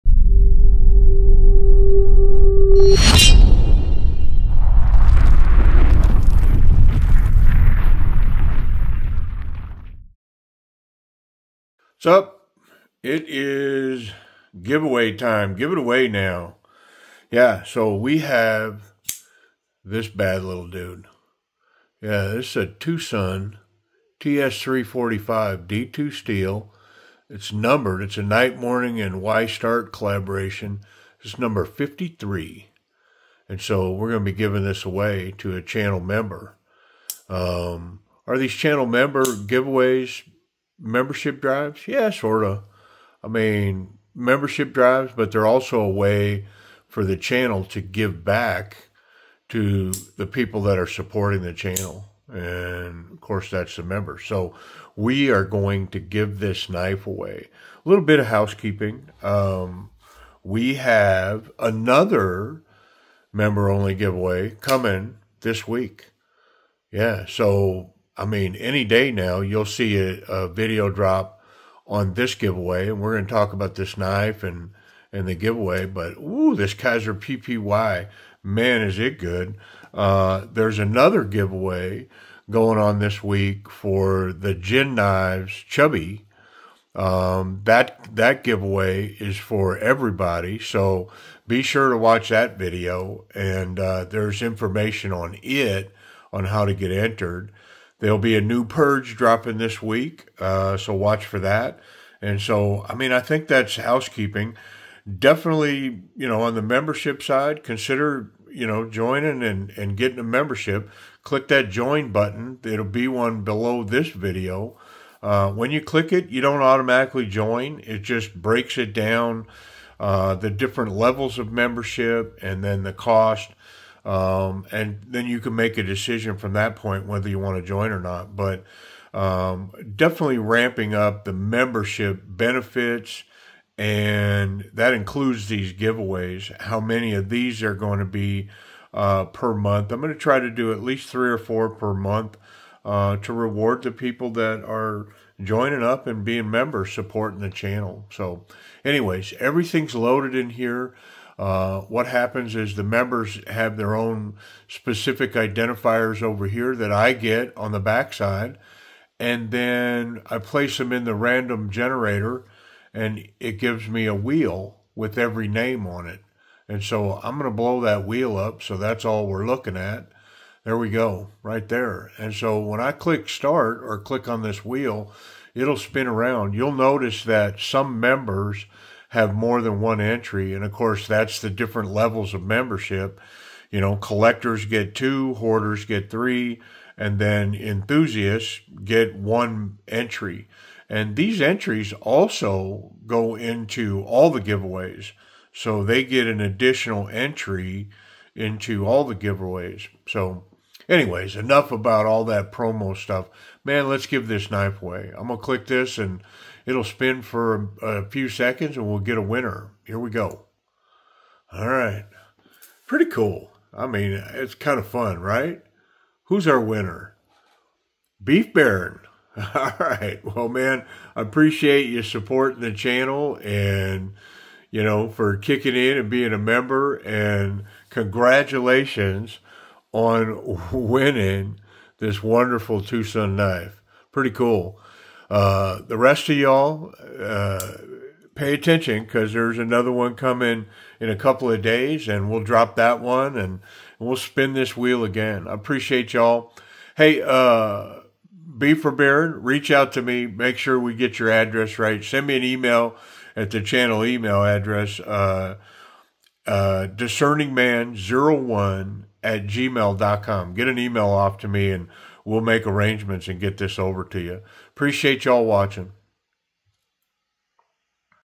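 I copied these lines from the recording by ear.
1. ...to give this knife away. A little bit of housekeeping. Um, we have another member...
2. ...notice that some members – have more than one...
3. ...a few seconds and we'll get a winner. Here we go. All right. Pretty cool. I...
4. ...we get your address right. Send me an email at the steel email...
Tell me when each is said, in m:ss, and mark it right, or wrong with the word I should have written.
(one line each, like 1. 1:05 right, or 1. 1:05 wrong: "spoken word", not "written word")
1. 0:55 right
2. 2:56 right
3. 3:27 right
4. 4:10 wrong: "channel", not "steel".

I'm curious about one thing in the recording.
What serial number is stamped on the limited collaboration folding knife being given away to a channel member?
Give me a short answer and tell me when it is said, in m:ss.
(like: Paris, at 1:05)
53, at 0:31.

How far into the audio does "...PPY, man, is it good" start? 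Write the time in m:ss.
1:17.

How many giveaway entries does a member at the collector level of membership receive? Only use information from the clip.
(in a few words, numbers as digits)
2.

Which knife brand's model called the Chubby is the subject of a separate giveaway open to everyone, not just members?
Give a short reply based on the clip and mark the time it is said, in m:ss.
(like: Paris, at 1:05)
Gin Knives, at 1:24.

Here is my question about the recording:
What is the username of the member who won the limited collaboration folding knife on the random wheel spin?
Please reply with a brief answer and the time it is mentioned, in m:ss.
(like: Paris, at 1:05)
Beef Baron, at 3:38.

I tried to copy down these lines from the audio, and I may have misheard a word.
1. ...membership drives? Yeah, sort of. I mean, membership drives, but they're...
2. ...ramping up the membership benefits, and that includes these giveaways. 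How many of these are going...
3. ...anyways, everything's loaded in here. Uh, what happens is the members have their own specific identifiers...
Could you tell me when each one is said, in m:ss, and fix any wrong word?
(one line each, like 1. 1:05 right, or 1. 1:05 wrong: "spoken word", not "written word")
1. 0:40 right
2. 2:10 right
3. 2:28 right.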